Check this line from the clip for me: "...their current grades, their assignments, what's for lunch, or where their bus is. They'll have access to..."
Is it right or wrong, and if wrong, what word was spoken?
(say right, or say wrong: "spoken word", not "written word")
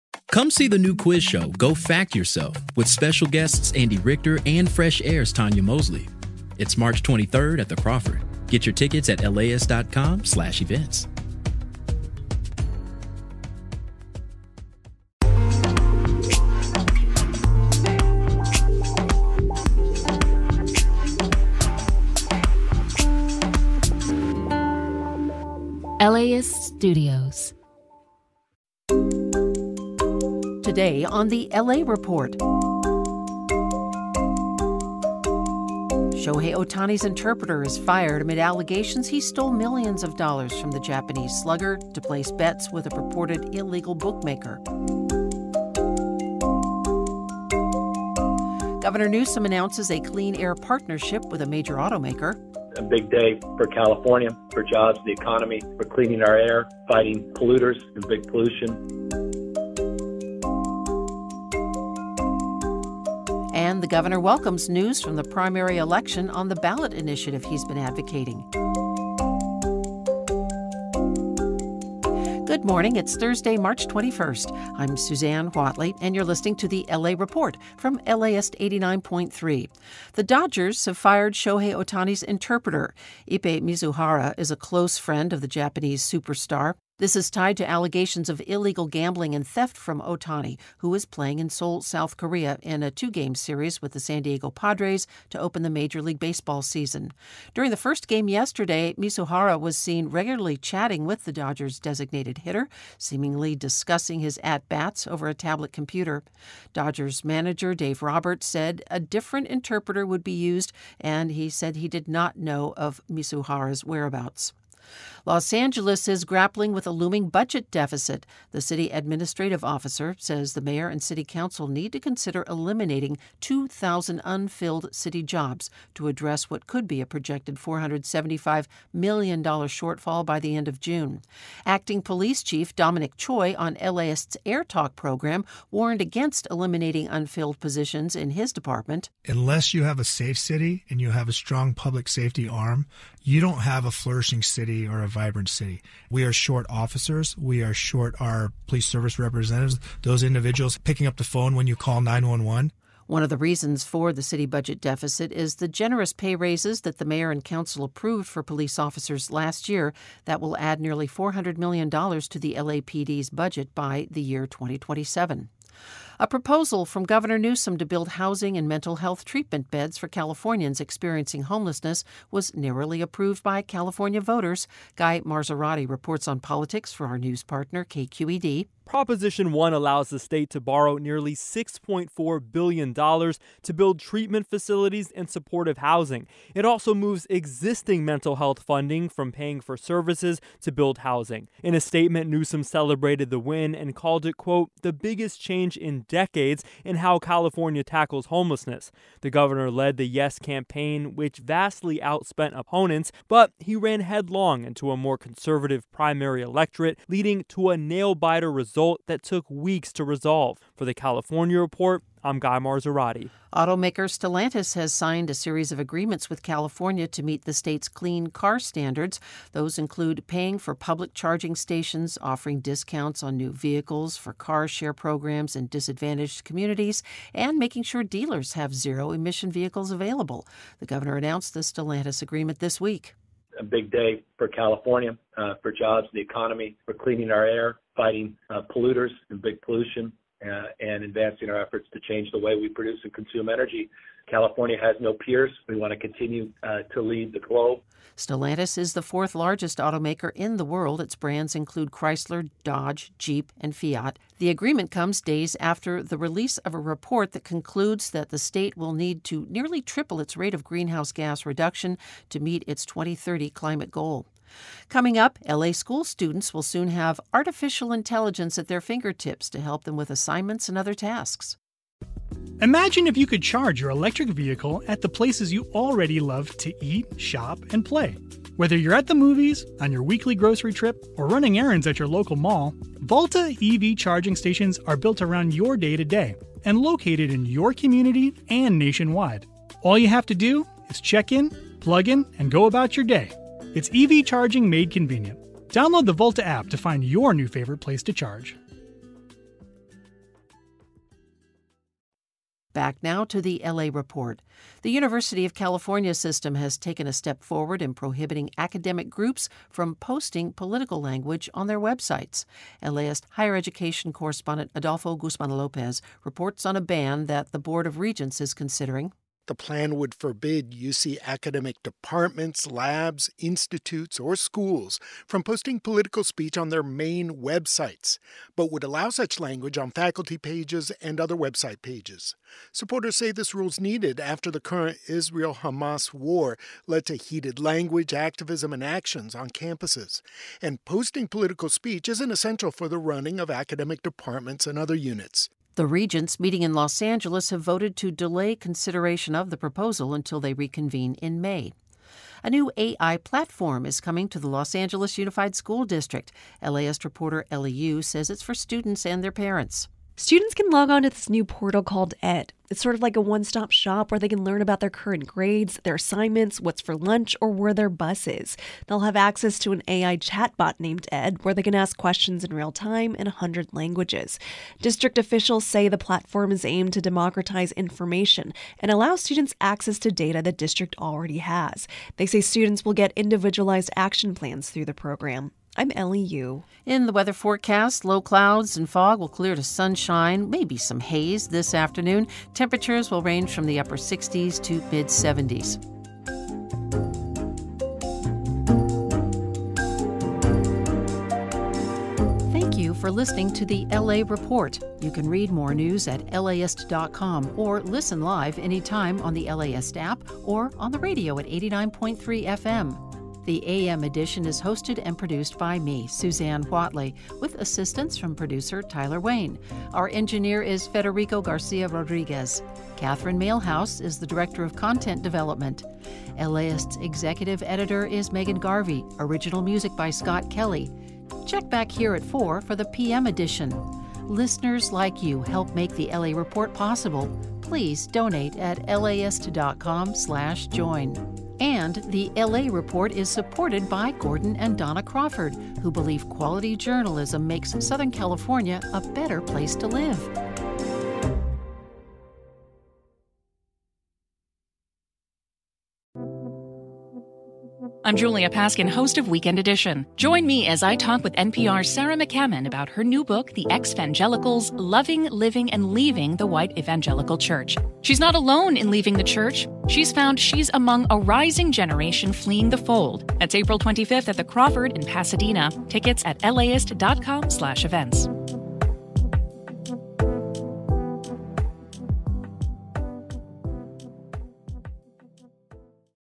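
right.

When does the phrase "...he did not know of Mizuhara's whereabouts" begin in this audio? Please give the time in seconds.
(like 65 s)
111 s.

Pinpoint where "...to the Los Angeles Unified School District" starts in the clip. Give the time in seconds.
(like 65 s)
354 s.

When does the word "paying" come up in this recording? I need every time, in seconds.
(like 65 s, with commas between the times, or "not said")
189 s, 220 s.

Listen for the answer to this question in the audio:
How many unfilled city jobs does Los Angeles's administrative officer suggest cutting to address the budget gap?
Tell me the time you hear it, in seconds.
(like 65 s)
123 s.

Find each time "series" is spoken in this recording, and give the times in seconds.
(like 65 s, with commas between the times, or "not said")
93 s, 215 s.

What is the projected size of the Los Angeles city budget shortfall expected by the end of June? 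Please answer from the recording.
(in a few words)
$475 million.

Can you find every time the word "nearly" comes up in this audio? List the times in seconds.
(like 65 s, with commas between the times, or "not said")
160 s, 180 s, 259 s.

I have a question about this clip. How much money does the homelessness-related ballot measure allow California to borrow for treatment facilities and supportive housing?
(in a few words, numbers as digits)
$6.4 billion.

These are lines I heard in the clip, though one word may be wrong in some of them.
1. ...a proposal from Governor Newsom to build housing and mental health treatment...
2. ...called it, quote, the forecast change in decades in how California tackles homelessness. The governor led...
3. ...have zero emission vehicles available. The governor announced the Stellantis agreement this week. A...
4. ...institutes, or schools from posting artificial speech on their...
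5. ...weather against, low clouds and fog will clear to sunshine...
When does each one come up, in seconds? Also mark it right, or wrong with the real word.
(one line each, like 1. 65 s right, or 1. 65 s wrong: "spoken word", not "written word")
1. 166 s right
2. 193 s wrong: "biggest", not "forecast"
3. 228 s right
4. 323 s wrong: "political", not "artificial"
5. 387 s wrong: "forecast", not "against".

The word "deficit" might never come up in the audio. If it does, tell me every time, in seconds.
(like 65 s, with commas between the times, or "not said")
117 s, 154 s.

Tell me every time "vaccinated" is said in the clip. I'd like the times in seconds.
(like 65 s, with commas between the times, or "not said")
not said.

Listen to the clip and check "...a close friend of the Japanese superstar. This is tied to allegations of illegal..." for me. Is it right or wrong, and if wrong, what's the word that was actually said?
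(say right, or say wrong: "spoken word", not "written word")
right.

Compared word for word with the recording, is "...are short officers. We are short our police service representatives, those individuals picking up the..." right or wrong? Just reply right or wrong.
right.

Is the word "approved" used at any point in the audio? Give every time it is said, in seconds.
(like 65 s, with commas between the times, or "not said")
157 s, 173 s.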